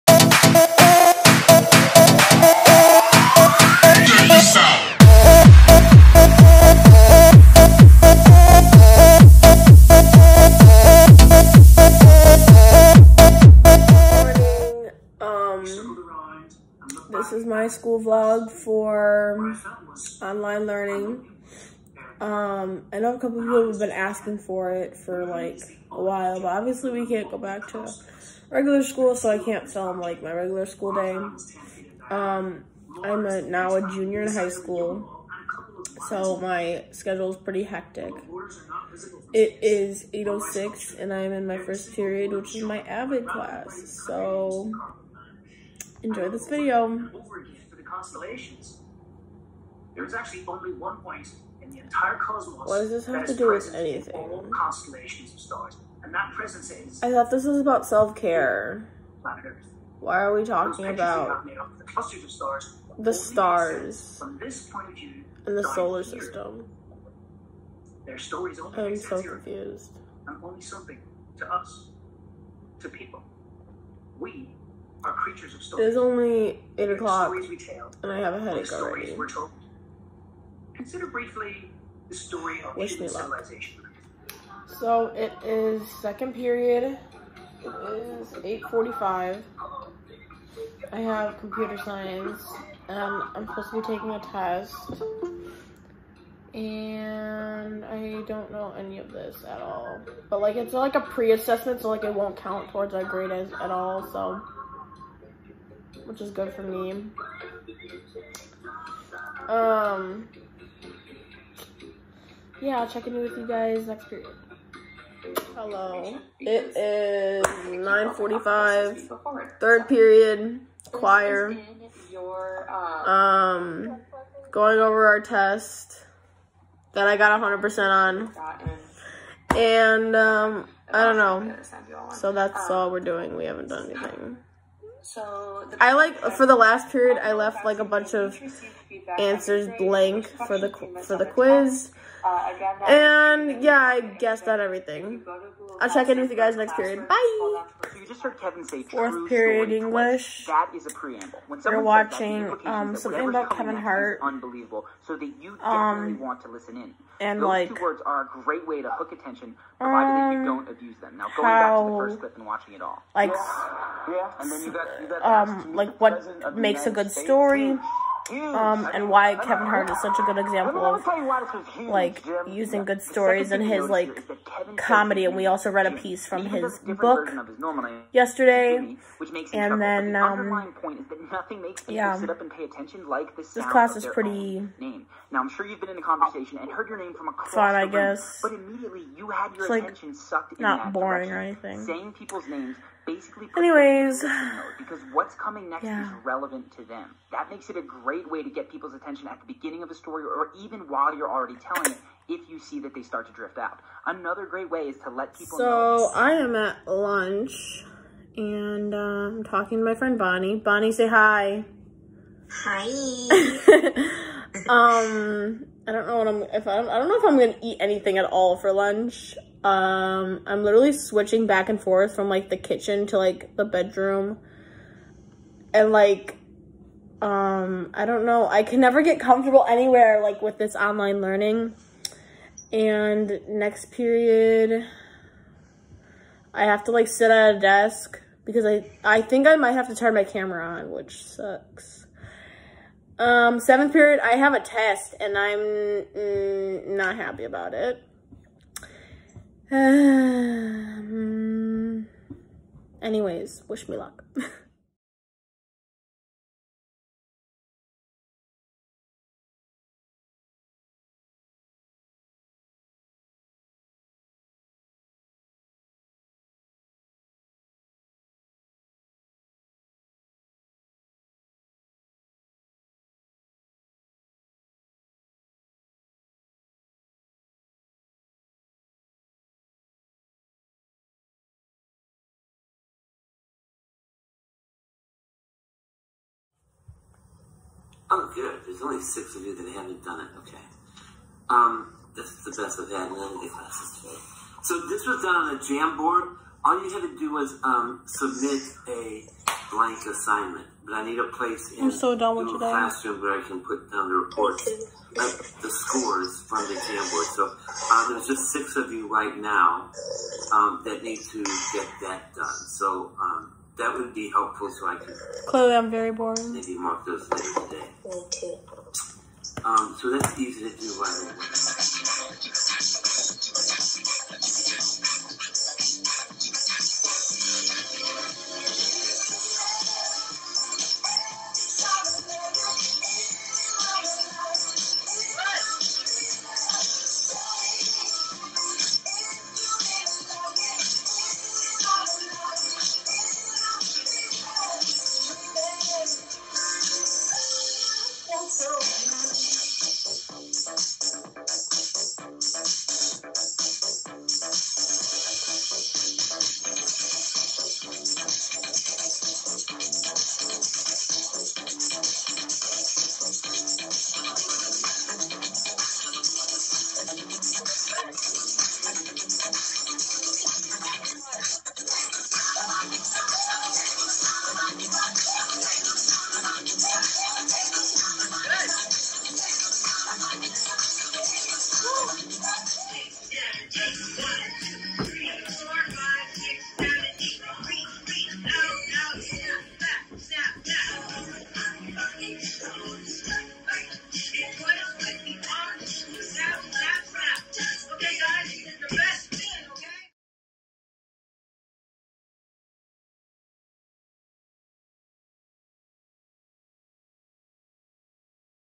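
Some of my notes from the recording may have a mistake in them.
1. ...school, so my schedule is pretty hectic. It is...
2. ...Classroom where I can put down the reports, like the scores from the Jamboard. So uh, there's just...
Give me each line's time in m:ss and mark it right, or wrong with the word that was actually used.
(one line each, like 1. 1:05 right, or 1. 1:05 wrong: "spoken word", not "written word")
1. 0:34 right
2. 5:02 right.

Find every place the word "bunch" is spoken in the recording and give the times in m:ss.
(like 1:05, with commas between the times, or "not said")
2:17.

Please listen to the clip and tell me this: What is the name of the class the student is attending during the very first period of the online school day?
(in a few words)
AVID.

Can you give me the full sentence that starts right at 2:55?
And we also read a piece from his book yesterday.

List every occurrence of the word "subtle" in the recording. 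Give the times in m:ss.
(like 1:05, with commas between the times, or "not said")
not said.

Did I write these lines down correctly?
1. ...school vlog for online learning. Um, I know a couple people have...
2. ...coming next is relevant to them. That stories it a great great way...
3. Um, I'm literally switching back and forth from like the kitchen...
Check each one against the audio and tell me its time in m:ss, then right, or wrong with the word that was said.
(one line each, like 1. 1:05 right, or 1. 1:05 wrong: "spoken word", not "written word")
1. 0:17 right
2. 3:15 wrong: "makes", not "stories"
3. 3:39 right.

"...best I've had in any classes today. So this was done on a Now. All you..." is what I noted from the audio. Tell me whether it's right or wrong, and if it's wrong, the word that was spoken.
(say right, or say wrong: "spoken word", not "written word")
wrong: "Jamboard", not "Now".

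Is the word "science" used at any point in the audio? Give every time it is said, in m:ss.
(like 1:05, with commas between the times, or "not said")
1:31.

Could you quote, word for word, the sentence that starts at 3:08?
But immediately you had your like, attention sucked in not boring or anything.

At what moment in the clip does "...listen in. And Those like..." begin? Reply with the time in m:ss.
2:36.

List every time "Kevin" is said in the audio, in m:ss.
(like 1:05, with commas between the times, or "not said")
2:28, 2:33, 2:49.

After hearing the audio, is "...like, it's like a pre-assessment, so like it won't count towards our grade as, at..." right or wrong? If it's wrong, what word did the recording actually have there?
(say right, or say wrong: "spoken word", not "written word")
right.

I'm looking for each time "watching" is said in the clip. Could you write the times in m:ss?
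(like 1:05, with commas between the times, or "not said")
2:31, 2:42.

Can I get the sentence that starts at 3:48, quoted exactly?
I can never get comfortable anywhere like with this online learning.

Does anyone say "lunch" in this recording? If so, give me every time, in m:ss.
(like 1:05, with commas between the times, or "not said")
3:26, 3:38.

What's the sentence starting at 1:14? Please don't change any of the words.
We are creatures of It is only 8 o'clock, and I have a headache already.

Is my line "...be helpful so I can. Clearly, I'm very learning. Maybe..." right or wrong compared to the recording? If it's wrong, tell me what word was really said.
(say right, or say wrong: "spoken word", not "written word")
wrong: "boring", not "learning".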